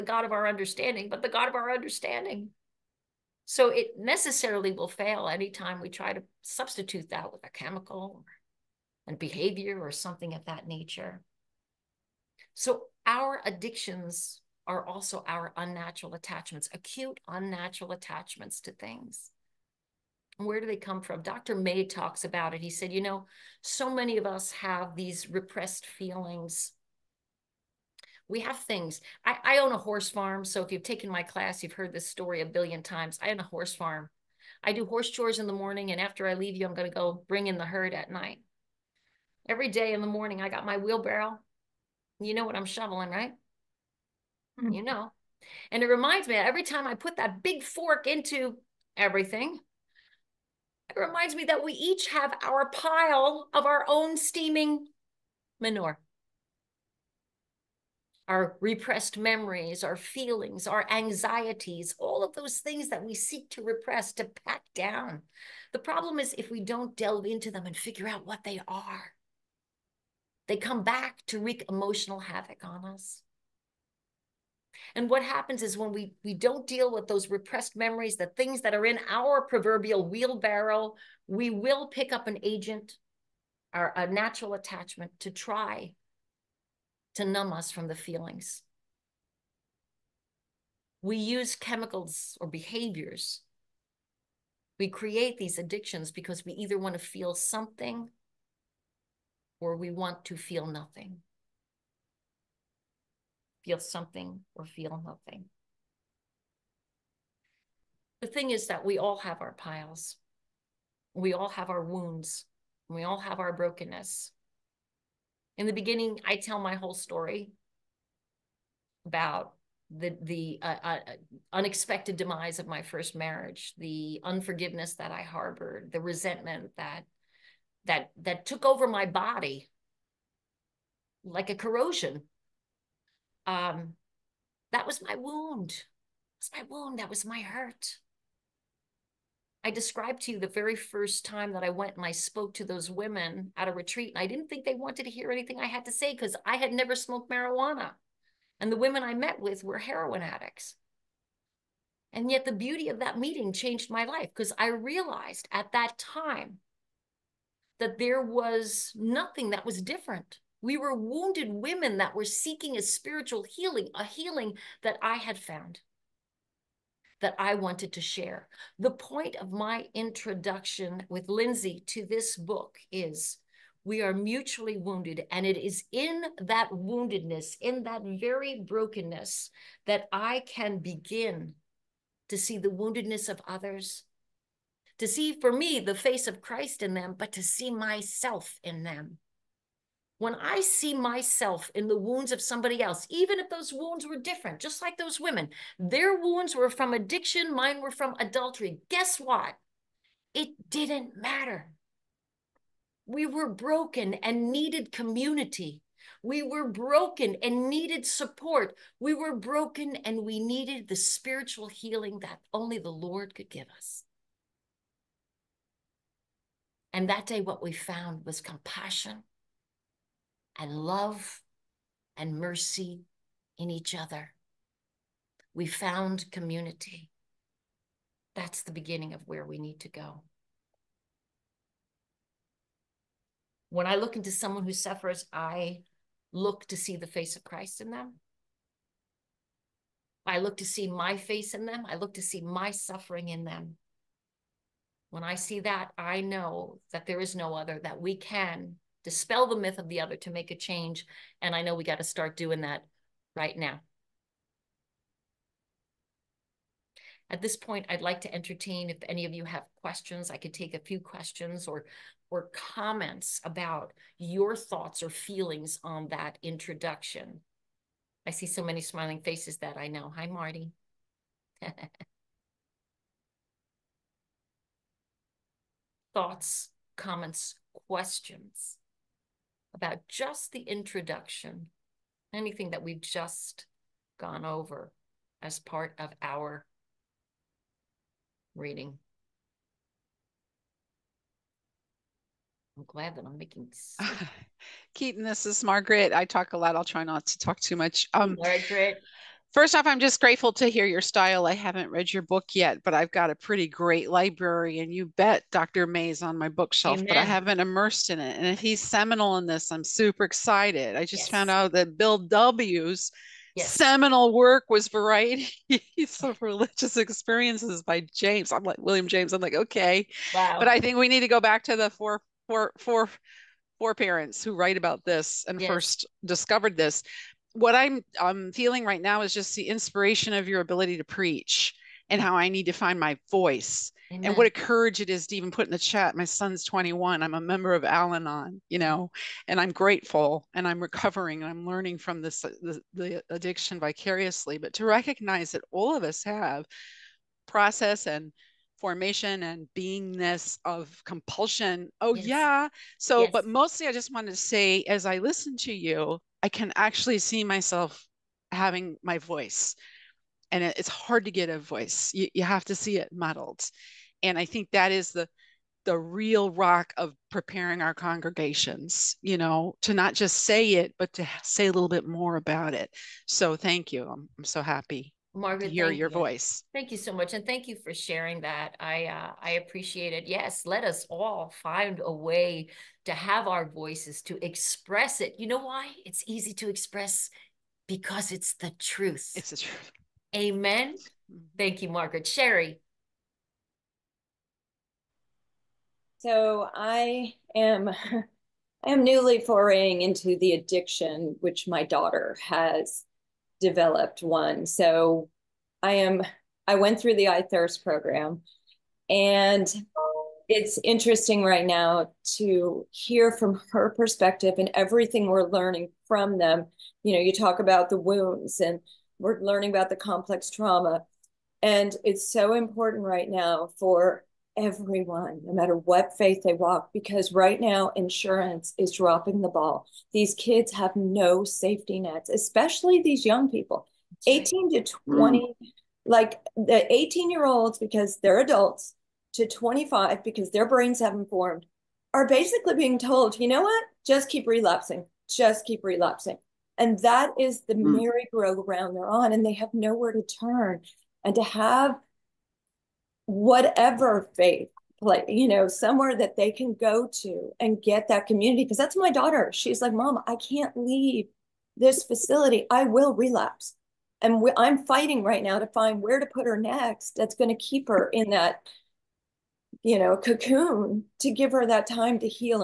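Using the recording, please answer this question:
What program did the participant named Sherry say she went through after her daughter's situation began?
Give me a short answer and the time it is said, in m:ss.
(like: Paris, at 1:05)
iThirst, at 6:47.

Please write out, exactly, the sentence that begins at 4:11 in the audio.
And I know we got to start doing that right now.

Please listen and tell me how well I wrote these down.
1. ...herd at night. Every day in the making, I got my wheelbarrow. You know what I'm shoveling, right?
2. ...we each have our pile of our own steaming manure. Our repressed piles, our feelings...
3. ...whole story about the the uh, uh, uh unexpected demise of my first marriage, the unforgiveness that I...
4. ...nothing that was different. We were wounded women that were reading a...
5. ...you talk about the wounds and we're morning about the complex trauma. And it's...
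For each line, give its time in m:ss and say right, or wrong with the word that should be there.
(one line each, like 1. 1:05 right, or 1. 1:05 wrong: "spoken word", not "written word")
1. 0:37 wrong: "morning", not "making"
2. 0:51 wrong: "memories", not "piles"
3. 1:56 right
4. 2:38 wrong: "seeking", not "reading"
5. 6:57 wrong: "learning", not "morning".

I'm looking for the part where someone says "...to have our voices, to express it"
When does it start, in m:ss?
6:23.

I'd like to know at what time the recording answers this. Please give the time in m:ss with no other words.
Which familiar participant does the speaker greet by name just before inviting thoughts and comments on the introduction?
4:30.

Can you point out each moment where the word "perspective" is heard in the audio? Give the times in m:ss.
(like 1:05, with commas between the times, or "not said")
6:53.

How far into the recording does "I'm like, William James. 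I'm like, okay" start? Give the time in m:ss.
5:18.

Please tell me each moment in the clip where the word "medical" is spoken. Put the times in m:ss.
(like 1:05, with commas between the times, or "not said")
not said.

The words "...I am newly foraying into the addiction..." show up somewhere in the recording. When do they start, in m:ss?
6:38.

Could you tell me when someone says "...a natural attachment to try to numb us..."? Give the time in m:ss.
1:23.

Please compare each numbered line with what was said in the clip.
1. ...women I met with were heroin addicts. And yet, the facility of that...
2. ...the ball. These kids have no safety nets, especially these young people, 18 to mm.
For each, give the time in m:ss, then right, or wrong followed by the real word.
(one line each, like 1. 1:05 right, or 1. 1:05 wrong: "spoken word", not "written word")
1. 2:28 wrong: "beauty", not "facility"
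2. 7:09 right.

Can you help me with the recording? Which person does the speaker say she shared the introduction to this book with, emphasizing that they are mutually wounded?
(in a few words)
Lindsay.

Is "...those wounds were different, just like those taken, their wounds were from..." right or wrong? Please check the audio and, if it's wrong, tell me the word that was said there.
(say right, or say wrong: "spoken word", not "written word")
wrong: "women", not "taken".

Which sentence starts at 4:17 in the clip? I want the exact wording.
At this point, I'd like to entertain if any of you have questions.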